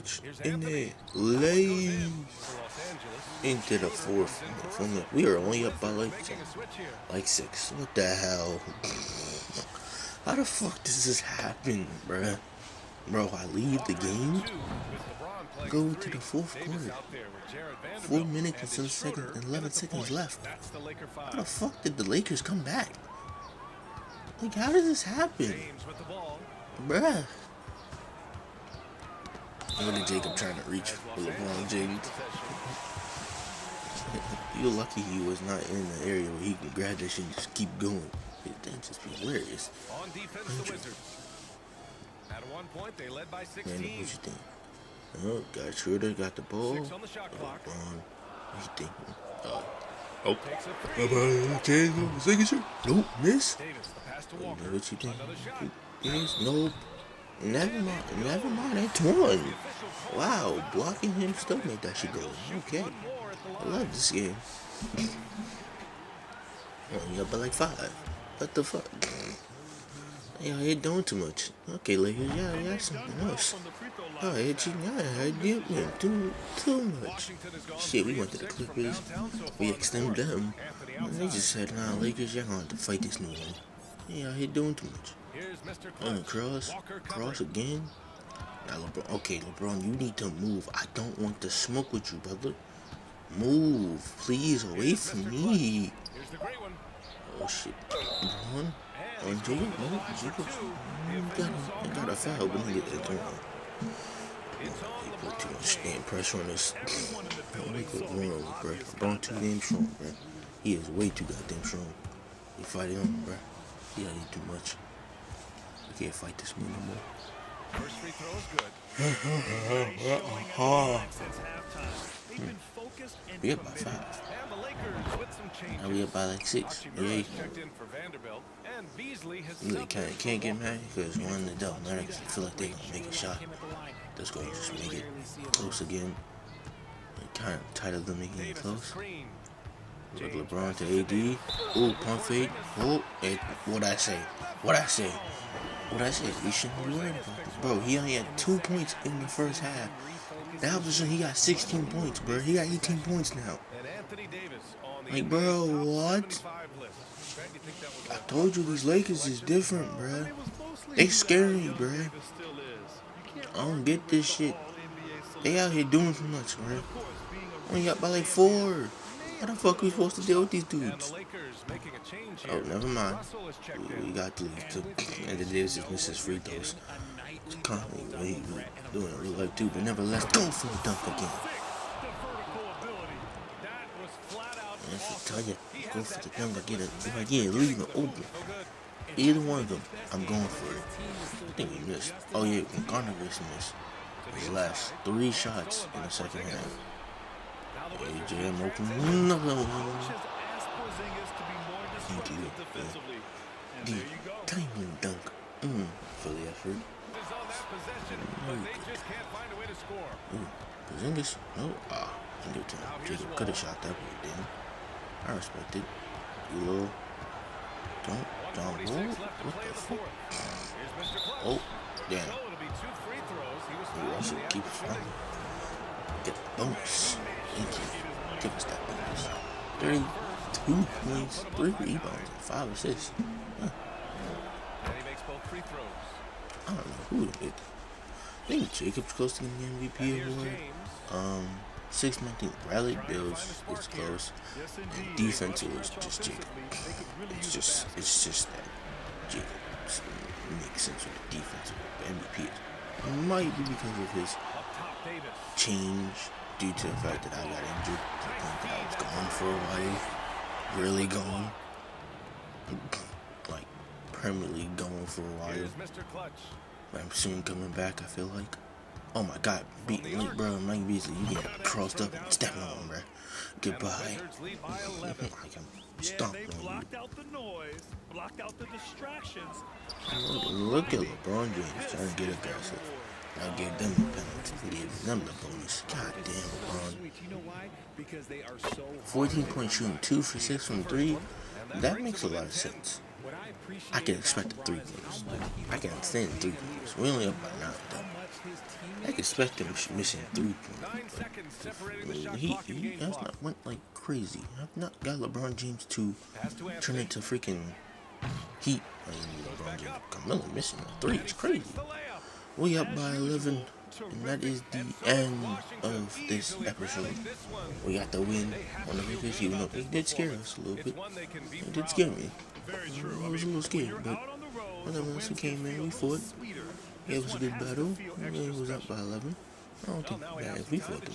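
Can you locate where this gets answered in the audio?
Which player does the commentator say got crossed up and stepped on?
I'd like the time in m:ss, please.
4:30.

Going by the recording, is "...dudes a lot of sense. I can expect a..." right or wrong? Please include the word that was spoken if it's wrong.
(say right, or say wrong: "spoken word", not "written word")
wrong: "makes", not "dudes".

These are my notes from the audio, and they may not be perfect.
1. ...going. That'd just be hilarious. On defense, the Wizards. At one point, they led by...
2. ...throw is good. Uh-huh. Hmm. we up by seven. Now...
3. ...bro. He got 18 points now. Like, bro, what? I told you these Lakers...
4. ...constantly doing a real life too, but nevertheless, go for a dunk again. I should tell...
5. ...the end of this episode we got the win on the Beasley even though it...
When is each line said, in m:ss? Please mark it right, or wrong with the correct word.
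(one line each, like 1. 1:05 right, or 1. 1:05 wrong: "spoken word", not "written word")
1. 0:37 right
2. 1:58 wrong: "five", not "seven"
3. 2:32 right
4. 2:57 right
5. 5:14 wrong: "Lakers", not "Beasley".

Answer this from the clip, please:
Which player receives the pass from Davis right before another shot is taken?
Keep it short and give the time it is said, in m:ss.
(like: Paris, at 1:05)
Walker, at 0:54.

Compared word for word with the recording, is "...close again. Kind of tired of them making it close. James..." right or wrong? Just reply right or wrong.
right.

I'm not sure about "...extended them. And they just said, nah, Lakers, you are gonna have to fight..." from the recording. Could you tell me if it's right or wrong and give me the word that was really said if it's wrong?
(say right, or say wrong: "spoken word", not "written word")
right.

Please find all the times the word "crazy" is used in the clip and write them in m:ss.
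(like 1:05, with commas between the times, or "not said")
5:03, 5:11.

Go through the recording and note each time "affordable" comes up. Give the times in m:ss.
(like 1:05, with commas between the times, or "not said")
not said.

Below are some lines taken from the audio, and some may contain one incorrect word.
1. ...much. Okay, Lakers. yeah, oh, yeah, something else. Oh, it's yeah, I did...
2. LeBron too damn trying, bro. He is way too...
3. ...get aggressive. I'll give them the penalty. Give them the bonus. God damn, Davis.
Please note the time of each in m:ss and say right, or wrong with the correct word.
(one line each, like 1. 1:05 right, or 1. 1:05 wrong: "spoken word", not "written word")
1. 1:11 right
2. 1:48 wrong: "strong", not "trying"
3. 4:42 wrong: "LeBron", not "Davis".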